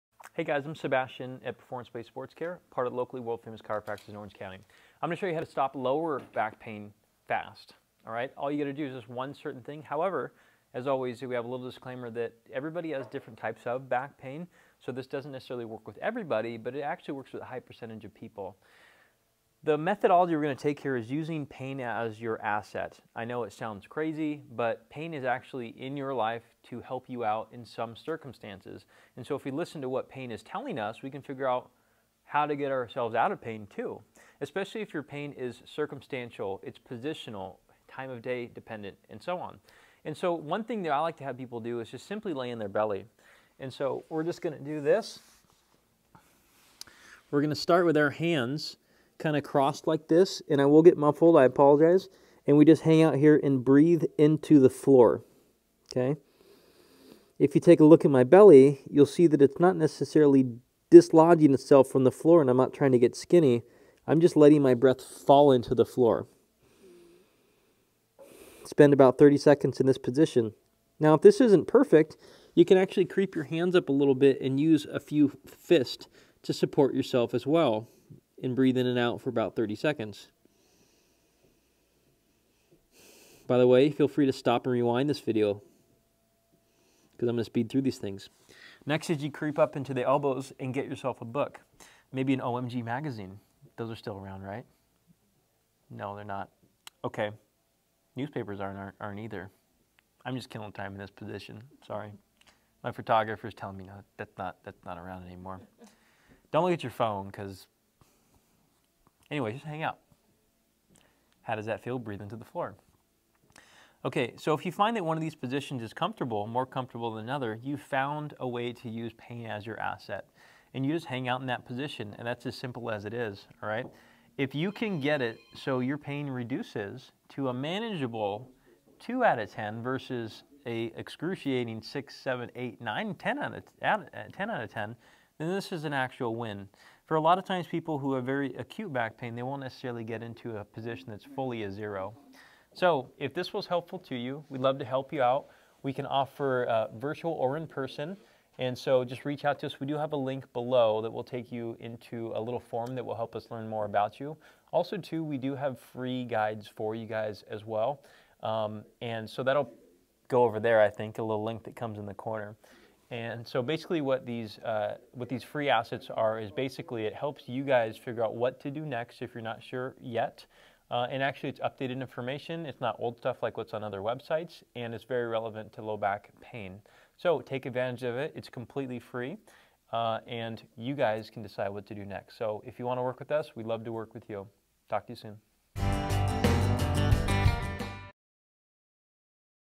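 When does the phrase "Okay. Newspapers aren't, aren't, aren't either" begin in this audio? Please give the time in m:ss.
1:37.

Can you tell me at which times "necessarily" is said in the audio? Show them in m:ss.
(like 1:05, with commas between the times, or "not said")
0:15, 0:59, 2:19.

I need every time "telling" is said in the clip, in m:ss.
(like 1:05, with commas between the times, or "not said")
0:30, 1:43.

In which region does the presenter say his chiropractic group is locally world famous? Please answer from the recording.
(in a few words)
Orange County.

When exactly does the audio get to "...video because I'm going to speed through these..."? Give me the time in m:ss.
1:25.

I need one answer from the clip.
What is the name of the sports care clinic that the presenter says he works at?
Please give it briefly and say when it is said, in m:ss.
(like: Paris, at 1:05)
Performance Place Sports Care, at 0:01.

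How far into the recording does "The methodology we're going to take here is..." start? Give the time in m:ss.
0:19.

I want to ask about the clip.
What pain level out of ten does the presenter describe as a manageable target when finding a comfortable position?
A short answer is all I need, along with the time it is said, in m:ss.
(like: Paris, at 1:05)
2, at 2:08.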